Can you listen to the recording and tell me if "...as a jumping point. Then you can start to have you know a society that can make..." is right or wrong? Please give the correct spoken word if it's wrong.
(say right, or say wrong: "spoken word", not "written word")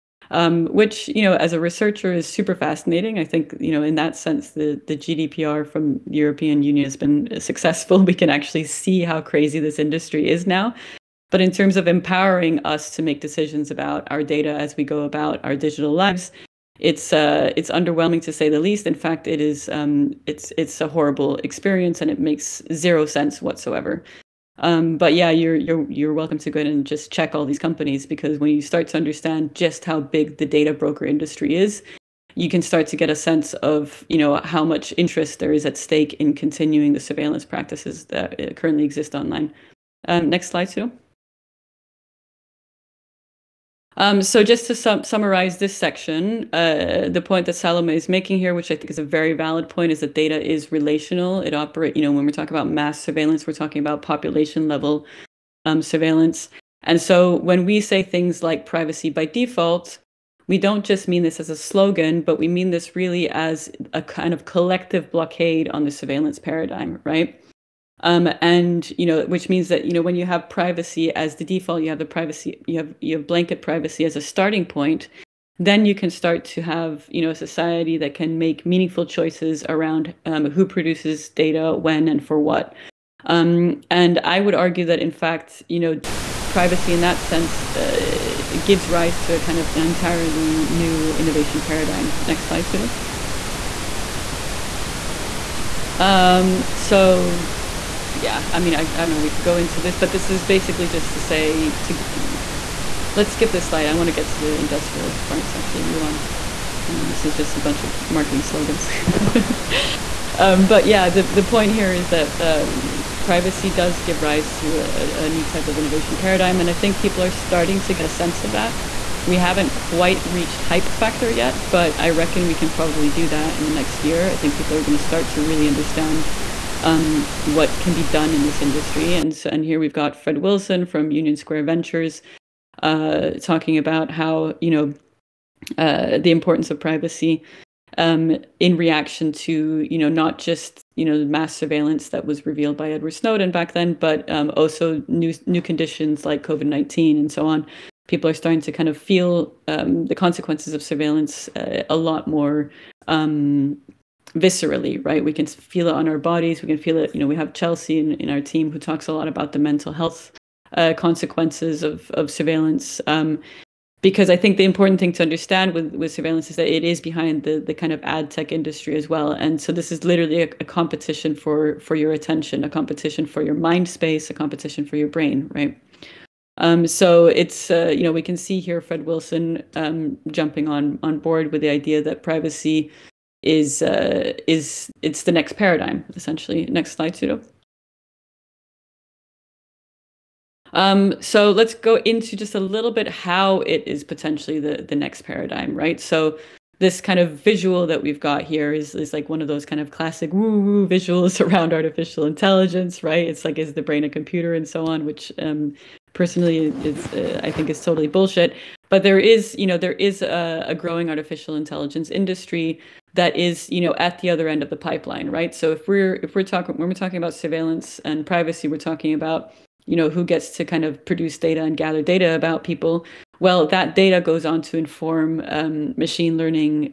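wrong: "starting", not "jumping".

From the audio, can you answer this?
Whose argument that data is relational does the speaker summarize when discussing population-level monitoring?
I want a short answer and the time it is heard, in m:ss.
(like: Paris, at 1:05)
Salome, at 0:47.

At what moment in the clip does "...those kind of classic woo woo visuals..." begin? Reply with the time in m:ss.
3:19.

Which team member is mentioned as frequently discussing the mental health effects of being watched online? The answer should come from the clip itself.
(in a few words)
Chelsea.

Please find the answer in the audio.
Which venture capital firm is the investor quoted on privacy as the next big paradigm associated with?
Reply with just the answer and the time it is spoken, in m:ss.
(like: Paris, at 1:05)
Union Square Ventures, at 2:11.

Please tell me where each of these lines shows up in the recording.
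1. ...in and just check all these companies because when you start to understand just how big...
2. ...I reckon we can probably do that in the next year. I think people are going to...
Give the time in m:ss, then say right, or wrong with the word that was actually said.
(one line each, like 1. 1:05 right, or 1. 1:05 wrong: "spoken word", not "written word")
1. 0:26 right
2. 2:01 right.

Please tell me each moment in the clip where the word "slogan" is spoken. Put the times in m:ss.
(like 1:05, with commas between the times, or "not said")
1:01, 1:48.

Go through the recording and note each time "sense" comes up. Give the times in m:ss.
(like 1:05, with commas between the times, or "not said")
0:04, 0:23, 0:33, 1:27, 1:58.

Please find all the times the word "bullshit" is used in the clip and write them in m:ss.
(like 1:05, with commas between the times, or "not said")
3:28.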